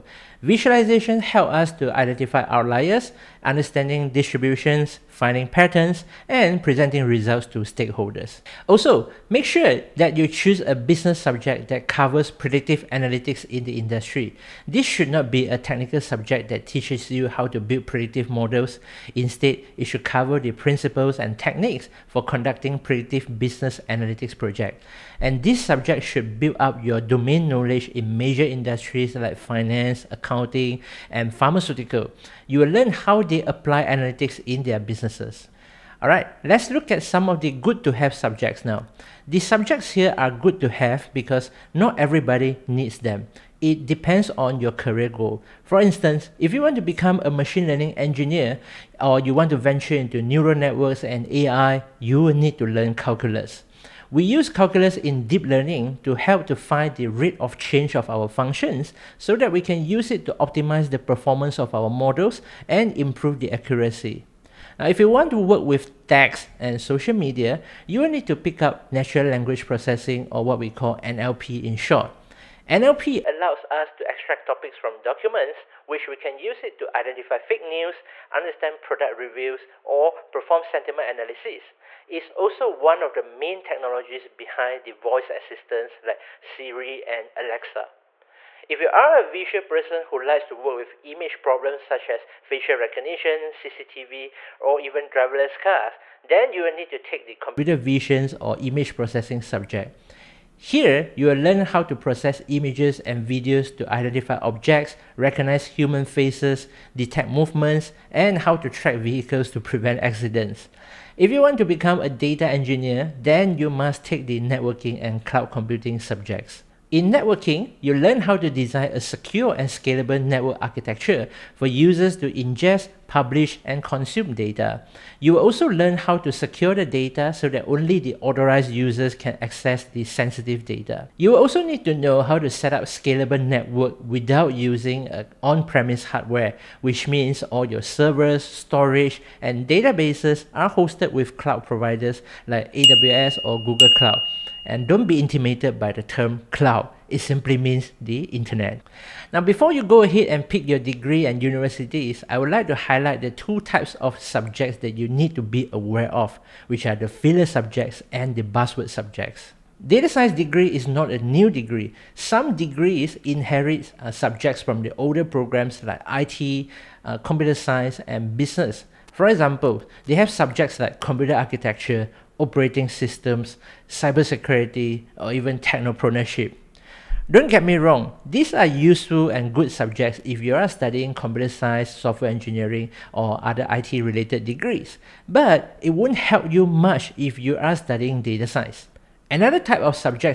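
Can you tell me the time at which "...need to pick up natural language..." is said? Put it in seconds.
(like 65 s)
68 s.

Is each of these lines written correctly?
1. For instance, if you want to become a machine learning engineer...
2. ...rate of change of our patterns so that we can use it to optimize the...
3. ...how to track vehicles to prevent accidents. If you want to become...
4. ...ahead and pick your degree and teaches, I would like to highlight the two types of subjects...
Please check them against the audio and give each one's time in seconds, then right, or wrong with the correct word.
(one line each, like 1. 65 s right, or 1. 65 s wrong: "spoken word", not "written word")
1. 45 s right
2. 57 s wrong: "functions", not "patterns"
3. 108 s right
4. 150 s wrong: "universities", not "teaches".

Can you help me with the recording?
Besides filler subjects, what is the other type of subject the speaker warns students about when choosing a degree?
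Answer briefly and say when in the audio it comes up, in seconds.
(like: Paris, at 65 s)
Buzzword subjects, at 158 s.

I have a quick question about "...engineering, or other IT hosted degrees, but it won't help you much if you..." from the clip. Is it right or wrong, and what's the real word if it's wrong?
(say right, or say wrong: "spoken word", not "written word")
wrong: "related", not "hosted".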